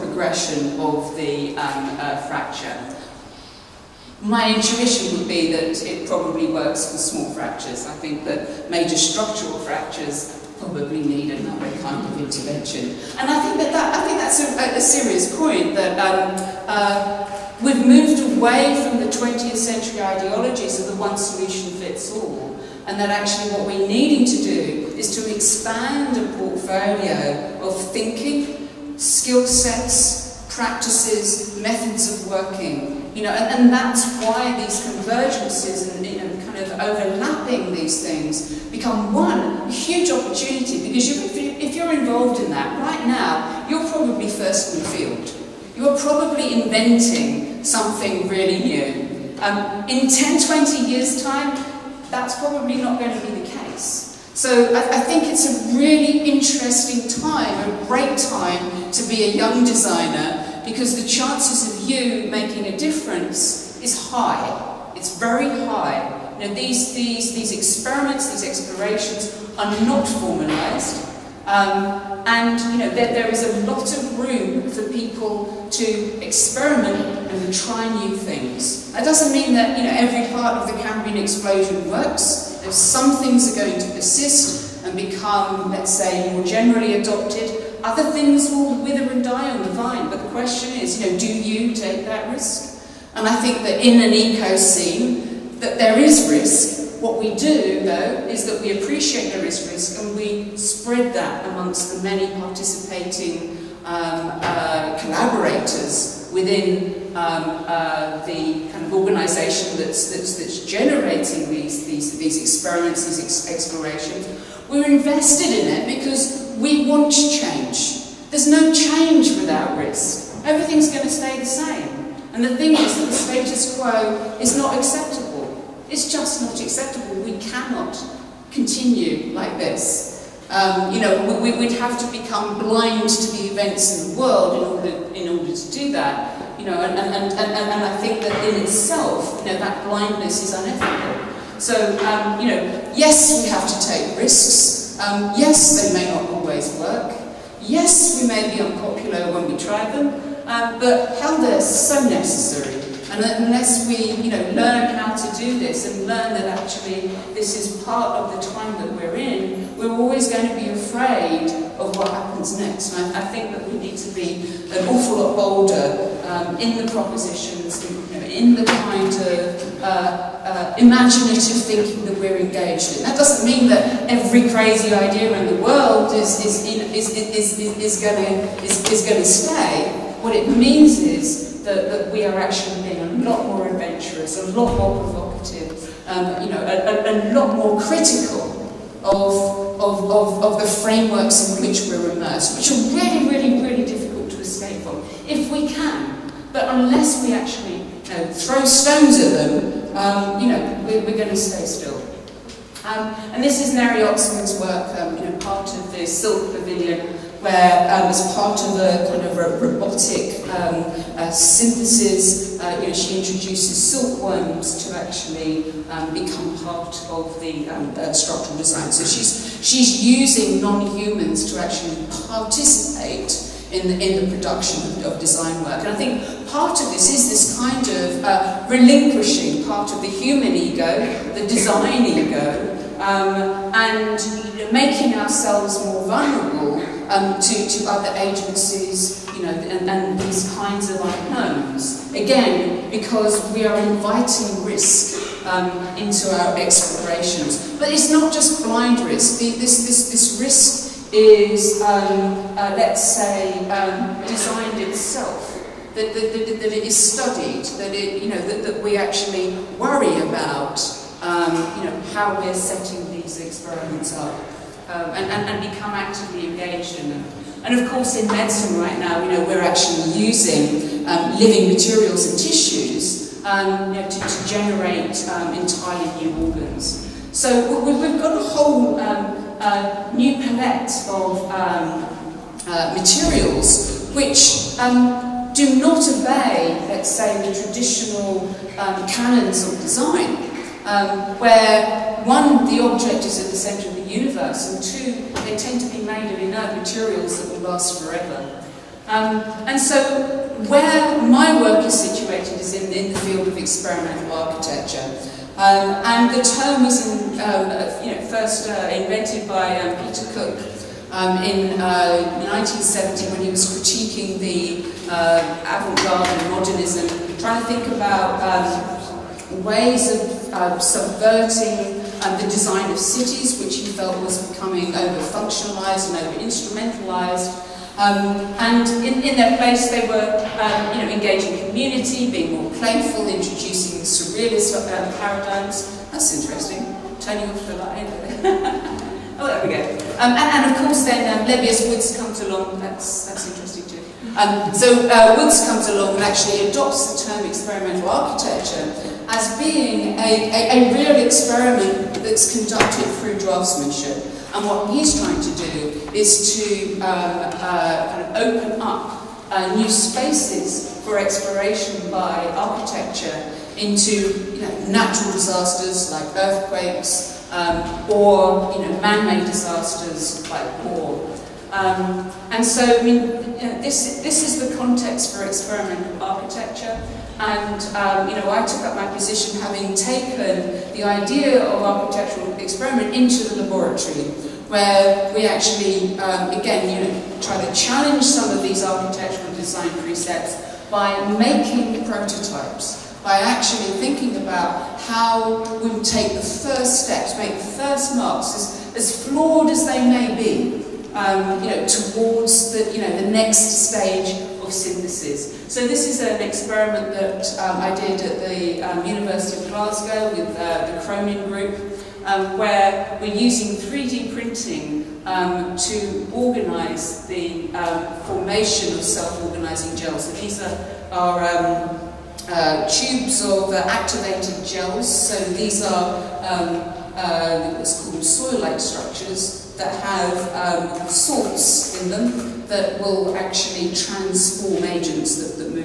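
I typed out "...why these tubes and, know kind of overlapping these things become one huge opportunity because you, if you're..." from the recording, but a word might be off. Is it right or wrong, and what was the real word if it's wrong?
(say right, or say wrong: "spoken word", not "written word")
wrong: "convergences", not "tubes".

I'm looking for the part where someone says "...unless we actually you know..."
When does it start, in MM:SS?
03:16.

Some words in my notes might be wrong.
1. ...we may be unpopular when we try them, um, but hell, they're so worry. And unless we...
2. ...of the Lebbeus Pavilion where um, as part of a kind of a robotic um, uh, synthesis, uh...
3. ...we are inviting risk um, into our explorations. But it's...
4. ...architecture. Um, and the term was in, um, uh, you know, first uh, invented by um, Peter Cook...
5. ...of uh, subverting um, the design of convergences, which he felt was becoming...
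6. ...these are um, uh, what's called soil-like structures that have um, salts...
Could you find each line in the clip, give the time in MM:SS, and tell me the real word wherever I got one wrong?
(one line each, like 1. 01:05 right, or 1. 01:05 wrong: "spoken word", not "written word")
1. 02:28 wrong: "necessary", not "worry"
2. 03:25 wrong: "Silk", not "Lebbeus"
3. 04:03 right
4. 05:04 right
5. 05:20 wrong: "cities", not "convergences"
6. 07:05 right.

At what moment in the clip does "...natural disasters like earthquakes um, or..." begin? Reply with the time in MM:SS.
06:04.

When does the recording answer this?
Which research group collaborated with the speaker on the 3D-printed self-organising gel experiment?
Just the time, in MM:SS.
06:51.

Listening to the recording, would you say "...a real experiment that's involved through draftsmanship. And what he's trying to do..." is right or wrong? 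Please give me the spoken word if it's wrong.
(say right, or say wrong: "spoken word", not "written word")
wrong: "conducted", not "involved".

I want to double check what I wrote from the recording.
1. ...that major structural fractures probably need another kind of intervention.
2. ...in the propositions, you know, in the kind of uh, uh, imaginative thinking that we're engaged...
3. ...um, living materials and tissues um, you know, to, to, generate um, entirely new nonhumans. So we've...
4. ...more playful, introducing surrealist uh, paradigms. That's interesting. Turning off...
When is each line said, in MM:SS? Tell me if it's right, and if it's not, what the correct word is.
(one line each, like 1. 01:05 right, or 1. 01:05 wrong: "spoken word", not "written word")
1. 00:08 right
2. 02:46 right
3. 04:31 wrong: "organs", not "nonhumans"
4. 05:32 right.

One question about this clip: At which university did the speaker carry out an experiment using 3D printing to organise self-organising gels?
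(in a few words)
University of Glasgow.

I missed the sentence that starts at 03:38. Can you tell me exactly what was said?
So she's, she's using non-humans to actually participate in the, in the production of, design work.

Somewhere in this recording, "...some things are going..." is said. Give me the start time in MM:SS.
01:22.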